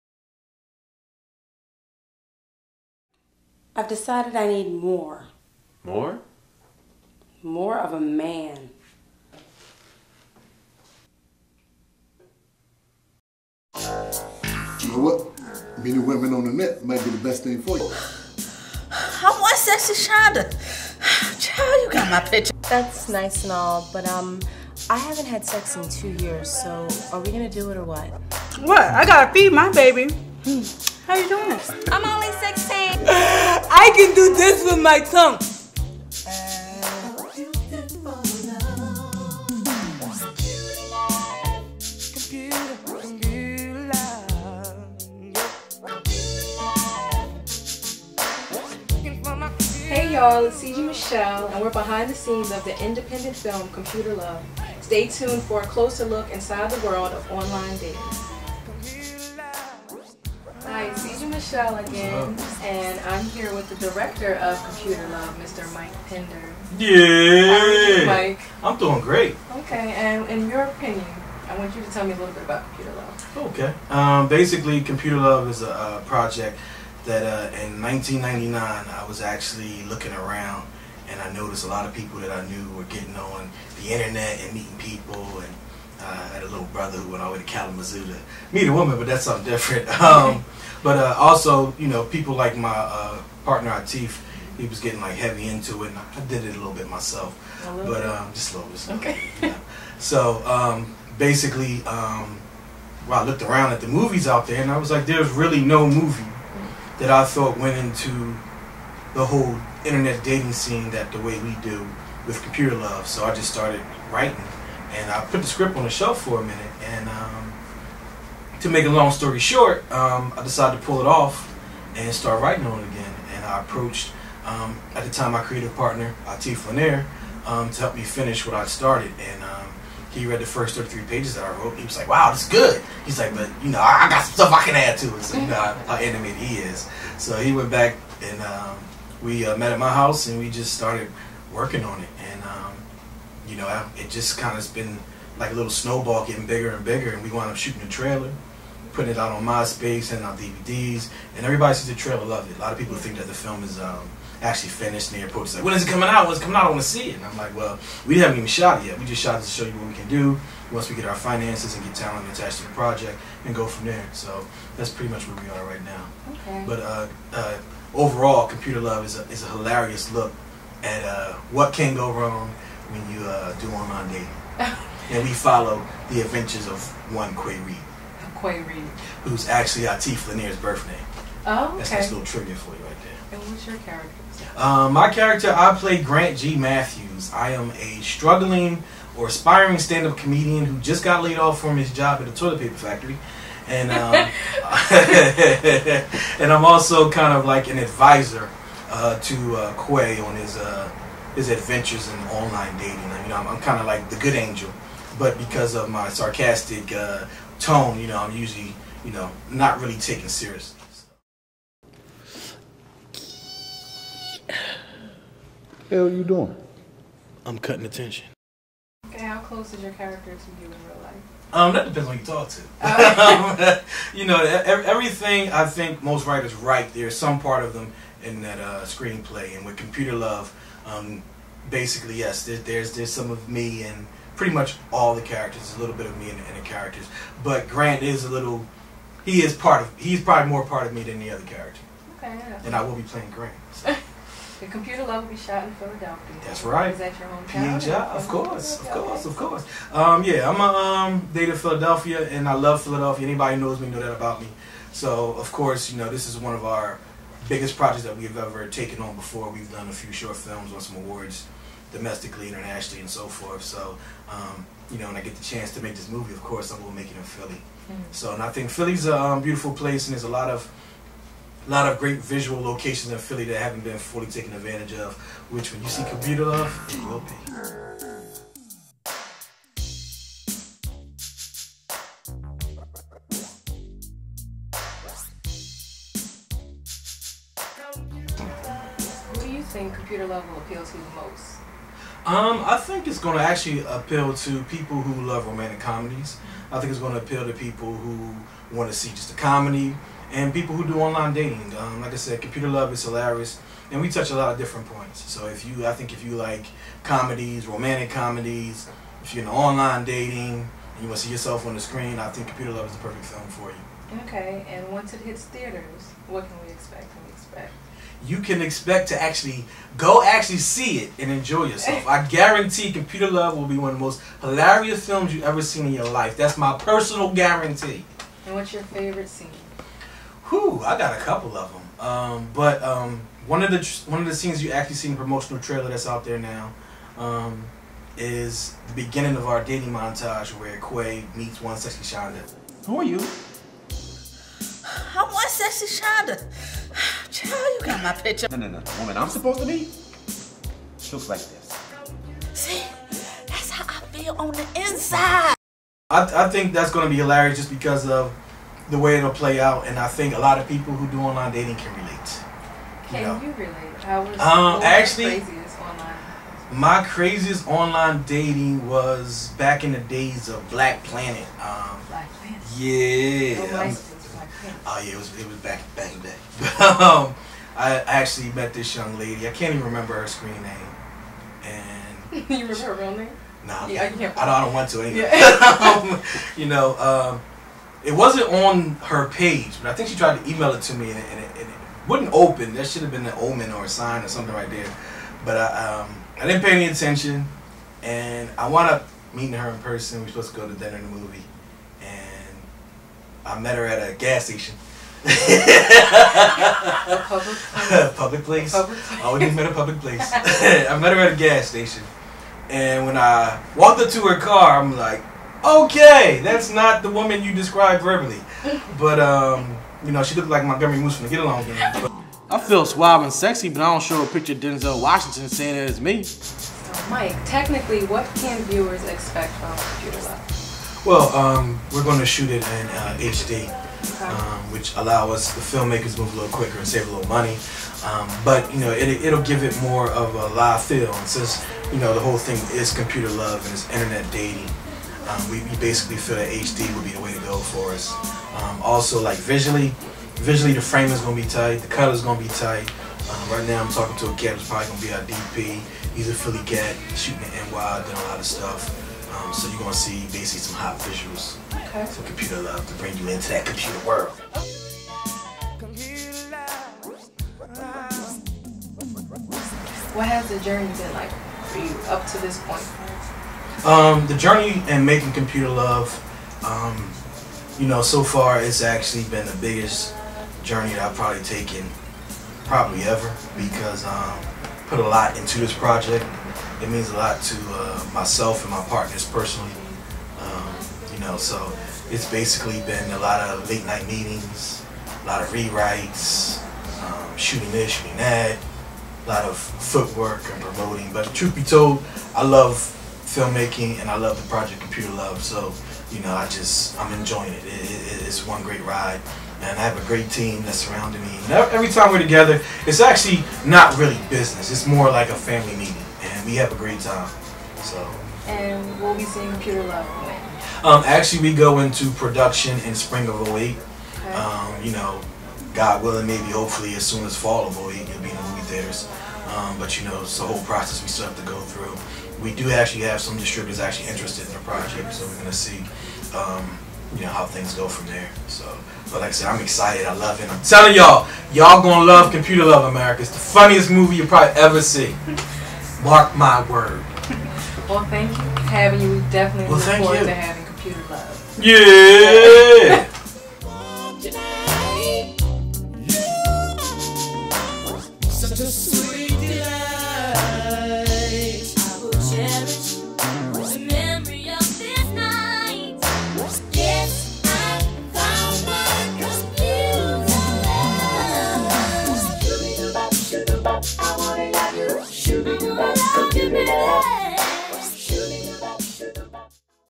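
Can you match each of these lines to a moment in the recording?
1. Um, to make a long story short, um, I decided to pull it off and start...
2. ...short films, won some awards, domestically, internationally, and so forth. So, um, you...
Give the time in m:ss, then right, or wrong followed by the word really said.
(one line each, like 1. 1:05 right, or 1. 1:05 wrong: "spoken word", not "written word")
1. 1:57 right
2. 4:20 right.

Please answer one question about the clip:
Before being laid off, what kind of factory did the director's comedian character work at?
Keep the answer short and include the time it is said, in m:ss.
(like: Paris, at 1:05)
toilet paper factory, at 3:12.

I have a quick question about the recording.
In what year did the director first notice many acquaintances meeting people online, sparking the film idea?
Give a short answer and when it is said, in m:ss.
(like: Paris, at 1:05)
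1999, at 1:17.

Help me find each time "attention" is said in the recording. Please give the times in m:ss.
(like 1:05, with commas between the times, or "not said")
3:37, 6:36.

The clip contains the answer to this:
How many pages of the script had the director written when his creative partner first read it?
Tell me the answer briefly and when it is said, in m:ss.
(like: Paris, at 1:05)
33, at 2:10.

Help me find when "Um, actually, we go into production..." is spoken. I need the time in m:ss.
8:40.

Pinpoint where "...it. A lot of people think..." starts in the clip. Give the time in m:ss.
2:32.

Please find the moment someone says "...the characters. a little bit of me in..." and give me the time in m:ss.
3:55.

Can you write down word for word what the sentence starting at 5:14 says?
Okay, and once it hits theaters, what can we expect?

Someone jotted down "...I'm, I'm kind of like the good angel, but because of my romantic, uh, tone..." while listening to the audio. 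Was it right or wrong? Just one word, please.
wrong.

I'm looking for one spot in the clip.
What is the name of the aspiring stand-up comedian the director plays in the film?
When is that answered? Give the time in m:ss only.
3:06.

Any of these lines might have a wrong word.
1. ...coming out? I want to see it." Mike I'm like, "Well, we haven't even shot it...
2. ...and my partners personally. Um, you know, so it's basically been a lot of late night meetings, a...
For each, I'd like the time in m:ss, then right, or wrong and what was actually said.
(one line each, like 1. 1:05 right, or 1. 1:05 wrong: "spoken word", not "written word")
1. 2:36 wrong: "And", not "Mike"
2. 8:08 right.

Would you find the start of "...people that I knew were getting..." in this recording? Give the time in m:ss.
1:21.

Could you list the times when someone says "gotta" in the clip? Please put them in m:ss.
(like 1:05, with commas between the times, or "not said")
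0:29.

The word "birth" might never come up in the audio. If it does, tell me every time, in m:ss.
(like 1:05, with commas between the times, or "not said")
3:00.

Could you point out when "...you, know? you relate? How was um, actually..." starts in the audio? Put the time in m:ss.
6:03.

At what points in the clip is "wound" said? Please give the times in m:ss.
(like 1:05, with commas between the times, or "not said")
2:27, 6:38.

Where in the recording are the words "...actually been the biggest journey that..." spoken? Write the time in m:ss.
7:58.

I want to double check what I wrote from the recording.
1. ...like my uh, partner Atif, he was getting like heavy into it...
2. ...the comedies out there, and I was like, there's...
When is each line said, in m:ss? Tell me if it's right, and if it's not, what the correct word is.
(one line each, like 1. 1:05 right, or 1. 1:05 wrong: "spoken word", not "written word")
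1. 1:32 right
2. 1:43 wrong: "movies", not "comedies".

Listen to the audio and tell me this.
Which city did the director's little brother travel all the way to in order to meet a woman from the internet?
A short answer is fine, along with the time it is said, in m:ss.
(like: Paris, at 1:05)
Kalamazoo, at 1:27.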